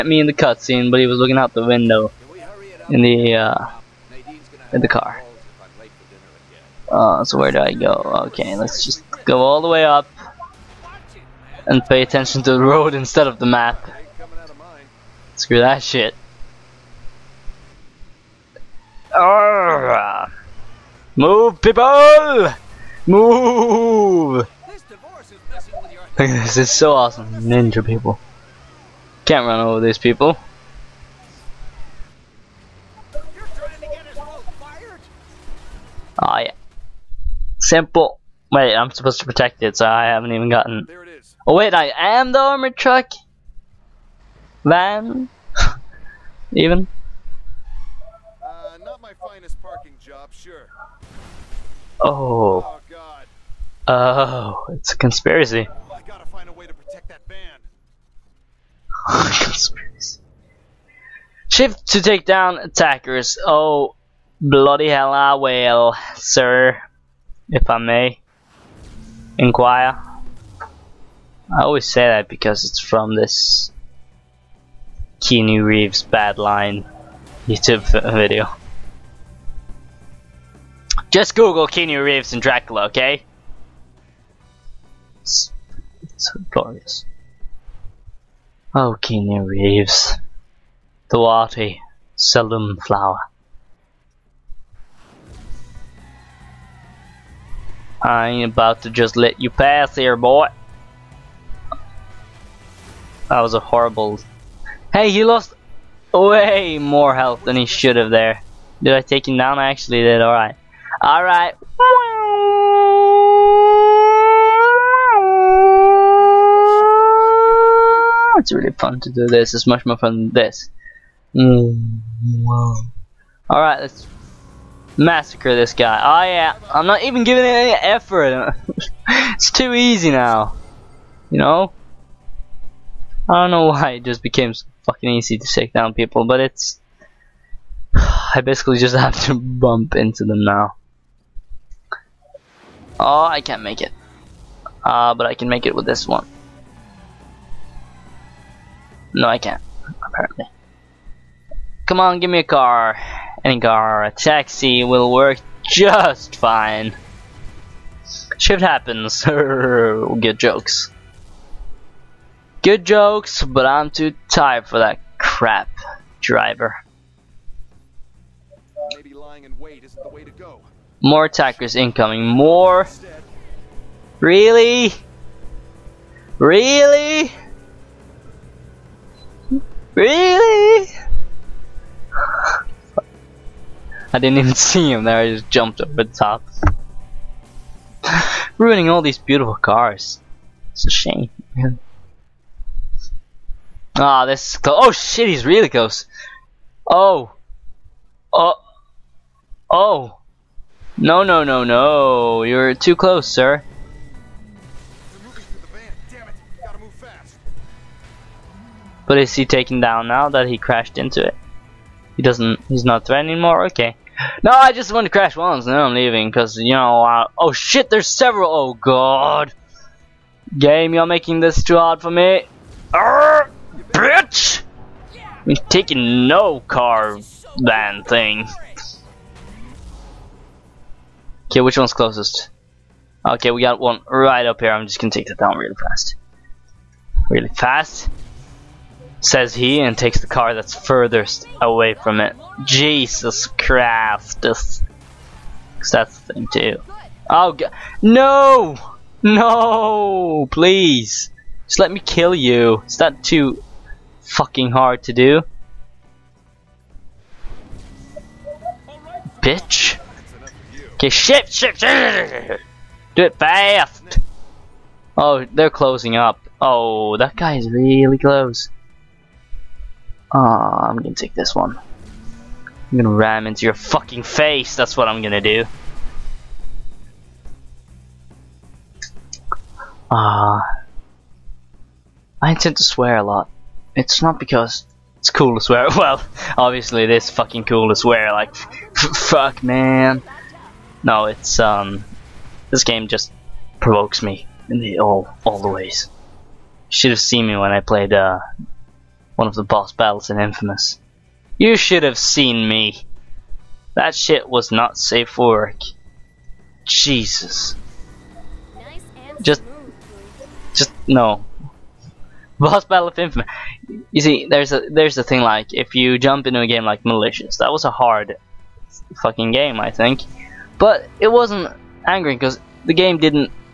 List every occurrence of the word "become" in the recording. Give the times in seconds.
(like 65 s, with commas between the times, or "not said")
not said.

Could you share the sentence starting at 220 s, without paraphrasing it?
Game, you're making this too hard for me.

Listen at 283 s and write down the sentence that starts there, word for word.
It's not because it's cool to swear.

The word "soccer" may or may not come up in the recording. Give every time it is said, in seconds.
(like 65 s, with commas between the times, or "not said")
not said.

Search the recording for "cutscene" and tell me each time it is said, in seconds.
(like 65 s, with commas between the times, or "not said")
0 s.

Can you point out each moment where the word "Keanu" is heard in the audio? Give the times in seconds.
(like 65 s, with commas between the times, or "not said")
75 s, 81 s, 89 s.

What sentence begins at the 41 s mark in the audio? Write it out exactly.
Oh wait, I am the armored truck van.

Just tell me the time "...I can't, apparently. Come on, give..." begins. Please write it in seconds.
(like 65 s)
149 s.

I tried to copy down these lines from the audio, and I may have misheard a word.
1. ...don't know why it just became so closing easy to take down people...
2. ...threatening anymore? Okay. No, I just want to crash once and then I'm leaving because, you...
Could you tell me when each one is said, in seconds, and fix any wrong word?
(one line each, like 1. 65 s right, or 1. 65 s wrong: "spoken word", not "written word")
1. 133 s wrong: "fucking", not "closing"
2. 213 s right.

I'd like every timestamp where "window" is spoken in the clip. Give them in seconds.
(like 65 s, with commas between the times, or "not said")
1 s.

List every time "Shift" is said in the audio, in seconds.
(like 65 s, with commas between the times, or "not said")
61 s, 158 s.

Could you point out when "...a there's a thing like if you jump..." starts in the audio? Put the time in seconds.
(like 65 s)
314 s.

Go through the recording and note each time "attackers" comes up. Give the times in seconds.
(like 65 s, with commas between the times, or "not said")
62 s, 171 s.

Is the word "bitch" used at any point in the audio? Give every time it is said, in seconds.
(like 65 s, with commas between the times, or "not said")
223 s, 259 s.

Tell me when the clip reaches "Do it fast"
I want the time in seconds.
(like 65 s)
263 s.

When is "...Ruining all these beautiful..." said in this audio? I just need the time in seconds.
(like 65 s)
188 s.